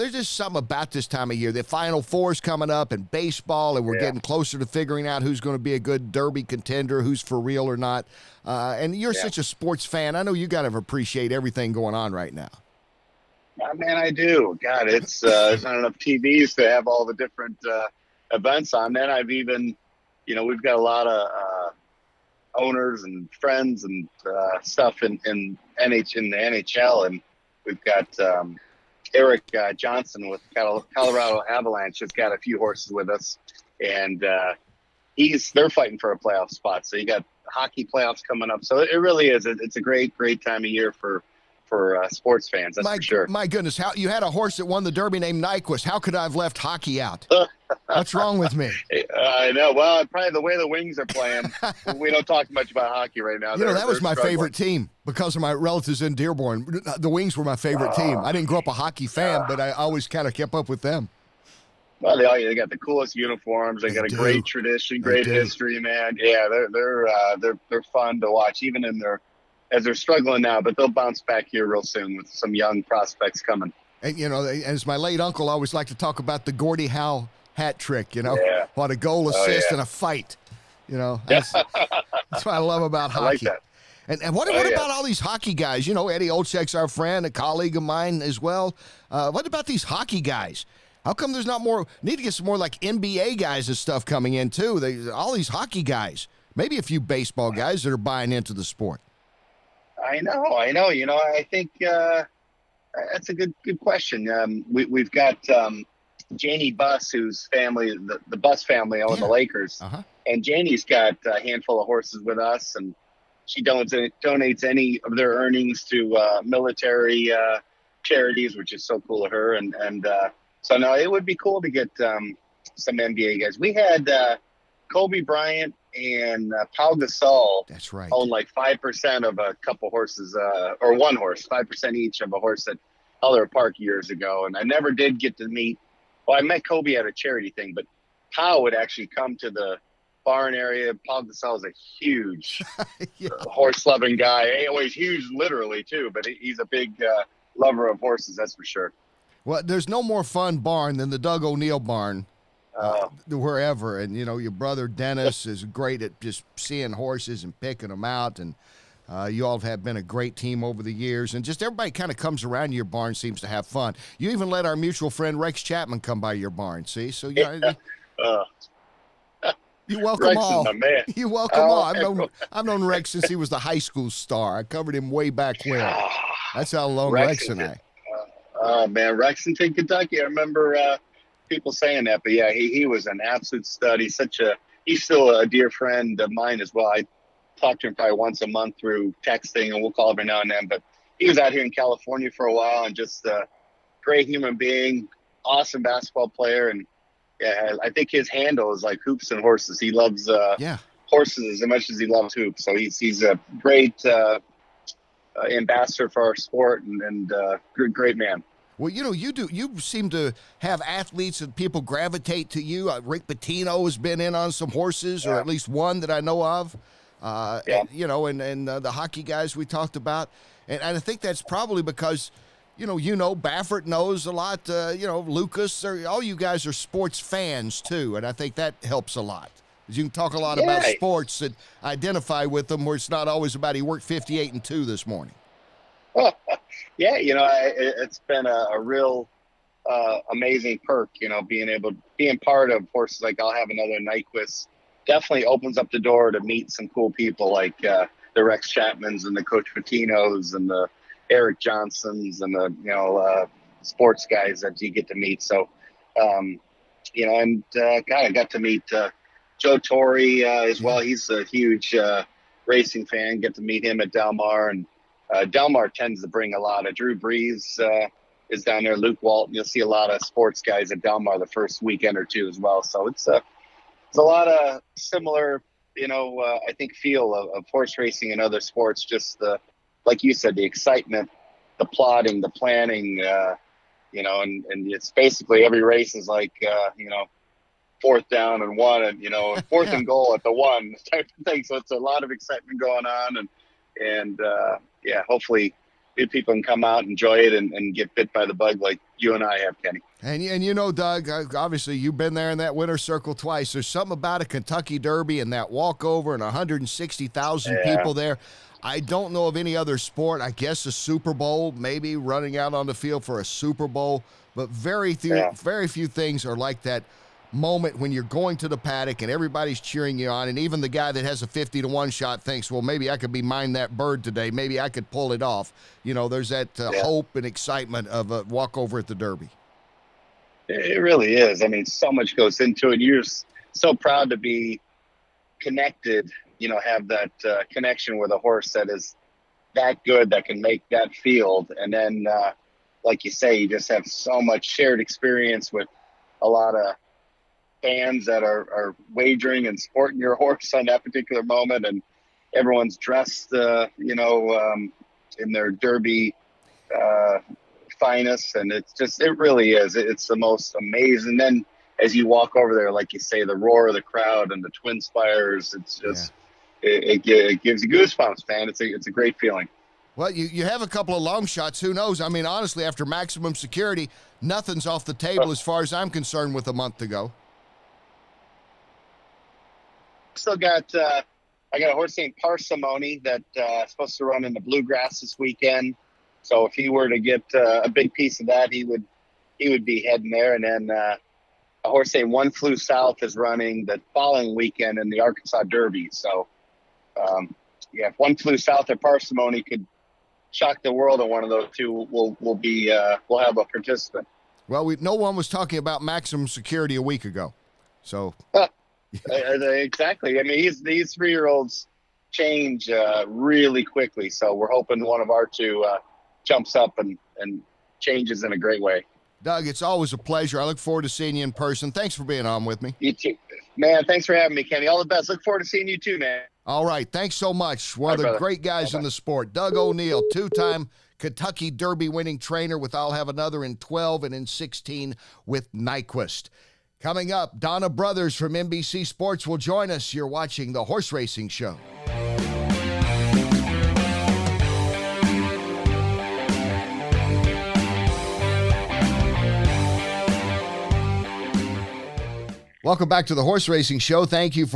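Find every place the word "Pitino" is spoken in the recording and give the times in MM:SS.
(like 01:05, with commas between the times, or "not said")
03:33, 04:09.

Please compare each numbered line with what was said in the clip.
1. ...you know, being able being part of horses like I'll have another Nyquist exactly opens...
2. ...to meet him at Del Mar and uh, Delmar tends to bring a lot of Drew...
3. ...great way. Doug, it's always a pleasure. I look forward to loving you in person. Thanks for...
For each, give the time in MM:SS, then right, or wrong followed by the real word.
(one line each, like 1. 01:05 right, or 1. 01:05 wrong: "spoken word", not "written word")
1. 04:01 wrong: "definitely", not "exactly"
2. 04:23 right
3. 06:58 wrong: "seeing", not "loving".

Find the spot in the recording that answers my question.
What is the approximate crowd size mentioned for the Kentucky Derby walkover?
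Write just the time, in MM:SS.
05:06.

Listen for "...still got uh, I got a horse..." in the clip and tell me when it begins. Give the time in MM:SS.
06:20.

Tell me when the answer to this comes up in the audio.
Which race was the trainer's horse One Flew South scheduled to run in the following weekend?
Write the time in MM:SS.
06:35.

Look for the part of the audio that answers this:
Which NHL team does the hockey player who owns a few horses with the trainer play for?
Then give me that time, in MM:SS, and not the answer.
00:30.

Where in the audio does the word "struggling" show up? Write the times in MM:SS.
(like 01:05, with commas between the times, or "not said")
00:54, 01:09.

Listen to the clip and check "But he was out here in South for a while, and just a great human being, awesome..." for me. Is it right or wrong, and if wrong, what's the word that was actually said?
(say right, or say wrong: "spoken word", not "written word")
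wrong: "California", not "South".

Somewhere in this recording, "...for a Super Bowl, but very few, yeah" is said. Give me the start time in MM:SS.
05:13.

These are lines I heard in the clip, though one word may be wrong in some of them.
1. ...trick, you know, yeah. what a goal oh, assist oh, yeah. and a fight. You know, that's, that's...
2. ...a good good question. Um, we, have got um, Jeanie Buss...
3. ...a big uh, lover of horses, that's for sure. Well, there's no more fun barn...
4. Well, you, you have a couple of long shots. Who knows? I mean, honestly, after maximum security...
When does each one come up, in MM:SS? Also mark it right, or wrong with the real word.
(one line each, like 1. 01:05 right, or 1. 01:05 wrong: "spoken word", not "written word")
1. 01:17 right
2. 01:43 right
3. 02:26 right
4. 06:10 right.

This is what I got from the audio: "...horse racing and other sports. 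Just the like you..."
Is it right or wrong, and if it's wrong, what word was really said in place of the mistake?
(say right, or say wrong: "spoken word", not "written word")
right.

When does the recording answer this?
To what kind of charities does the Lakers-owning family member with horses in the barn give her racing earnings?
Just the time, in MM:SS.
01:56.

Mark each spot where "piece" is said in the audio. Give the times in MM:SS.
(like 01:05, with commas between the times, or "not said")
06:28.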